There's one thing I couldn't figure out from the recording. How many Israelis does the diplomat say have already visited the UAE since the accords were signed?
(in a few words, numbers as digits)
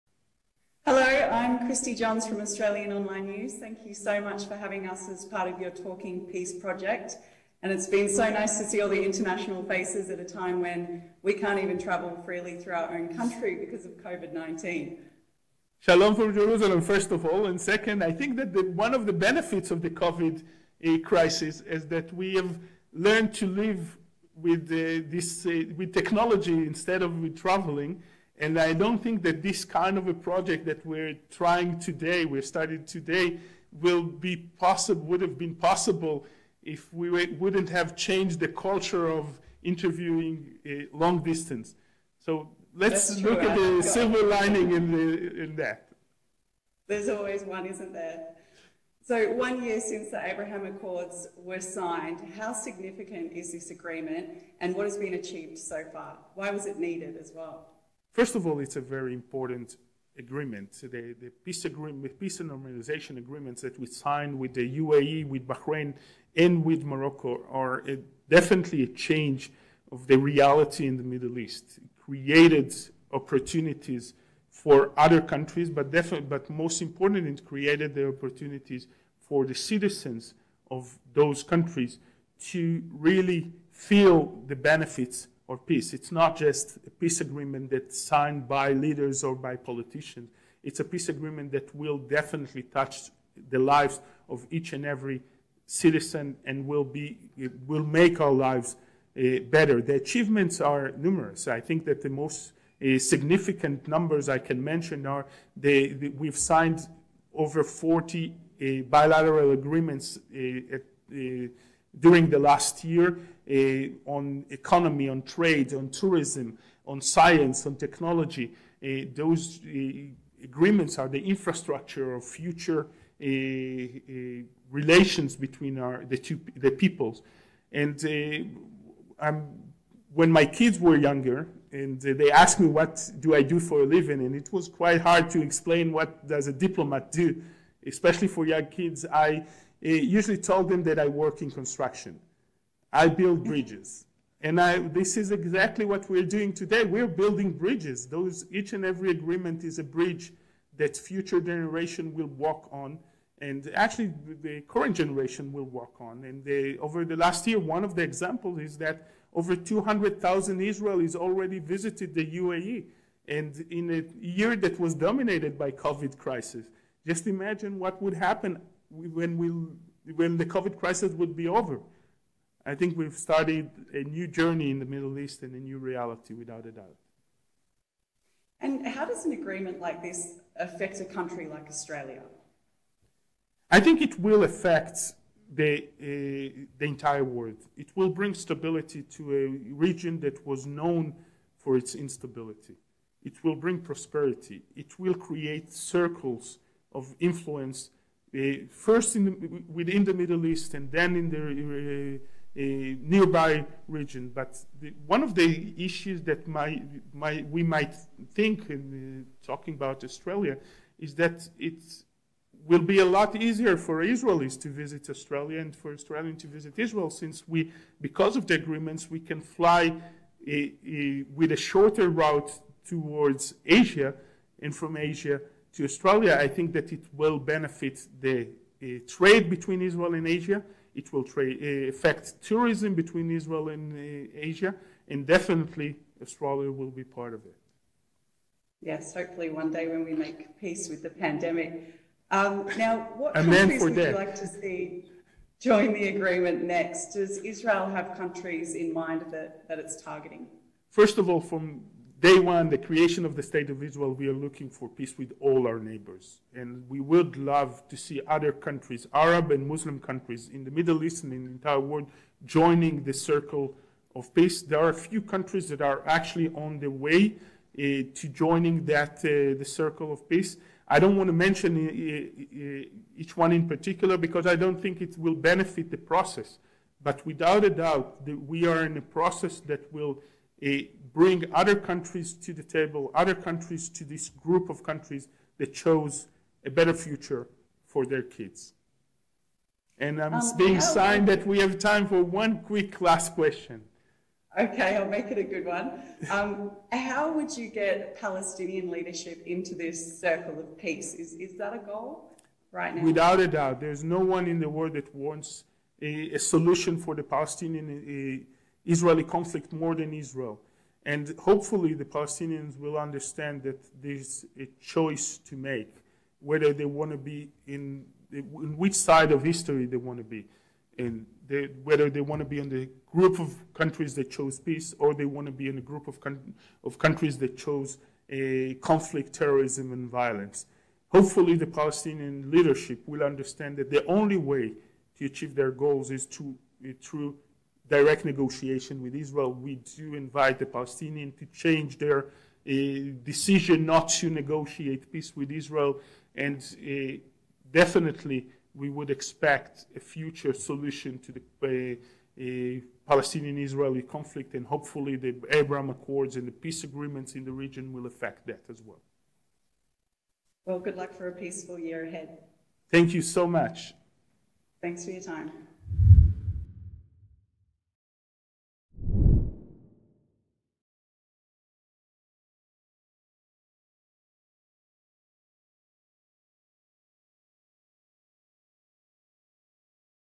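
over 200,000.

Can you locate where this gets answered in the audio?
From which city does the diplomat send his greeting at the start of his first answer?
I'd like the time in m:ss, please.
0:16.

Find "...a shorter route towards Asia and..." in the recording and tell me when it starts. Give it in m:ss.
3:41.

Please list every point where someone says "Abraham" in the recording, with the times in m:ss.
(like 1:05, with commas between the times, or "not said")
0:50, 5:55.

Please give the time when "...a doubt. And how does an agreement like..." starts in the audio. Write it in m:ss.
2:56.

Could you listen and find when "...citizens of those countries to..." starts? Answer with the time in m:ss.
1:19.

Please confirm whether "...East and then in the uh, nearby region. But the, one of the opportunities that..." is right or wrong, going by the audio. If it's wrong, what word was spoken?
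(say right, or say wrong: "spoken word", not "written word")
wrong: "issues", not "opportunities".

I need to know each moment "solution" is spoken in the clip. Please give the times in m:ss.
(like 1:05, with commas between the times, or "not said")
5:06, 5:50.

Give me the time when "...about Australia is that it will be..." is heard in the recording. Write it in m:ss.
3:29.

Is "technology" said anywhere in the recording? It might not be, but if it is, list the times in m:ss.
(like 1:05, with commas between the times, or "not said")
0:25, 1:57.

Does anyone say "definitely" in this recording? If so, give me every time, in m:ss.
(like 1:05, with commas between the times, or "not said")
1:08, 1:15, 1:31, 3:55, 5:47.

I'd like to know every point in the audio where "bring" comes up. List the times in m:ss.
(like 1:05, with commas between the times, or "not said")
3:08, 3:13, 4:41.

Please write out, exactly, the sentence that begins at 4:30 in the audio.
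I don't want to mention eh, each one in particular because I don't think it will benefit the process.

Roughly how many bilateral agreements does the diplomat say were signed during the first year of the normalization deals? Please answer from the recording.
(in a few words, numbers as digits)
over 40.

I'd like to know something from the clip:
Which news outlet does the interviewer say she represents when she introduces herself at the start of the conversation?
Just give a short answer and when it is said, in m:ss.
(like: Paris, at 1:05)
Australian Online News, at 0:02.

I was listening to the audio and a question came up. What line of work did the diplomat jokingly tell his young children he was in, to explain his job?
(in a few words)
construction.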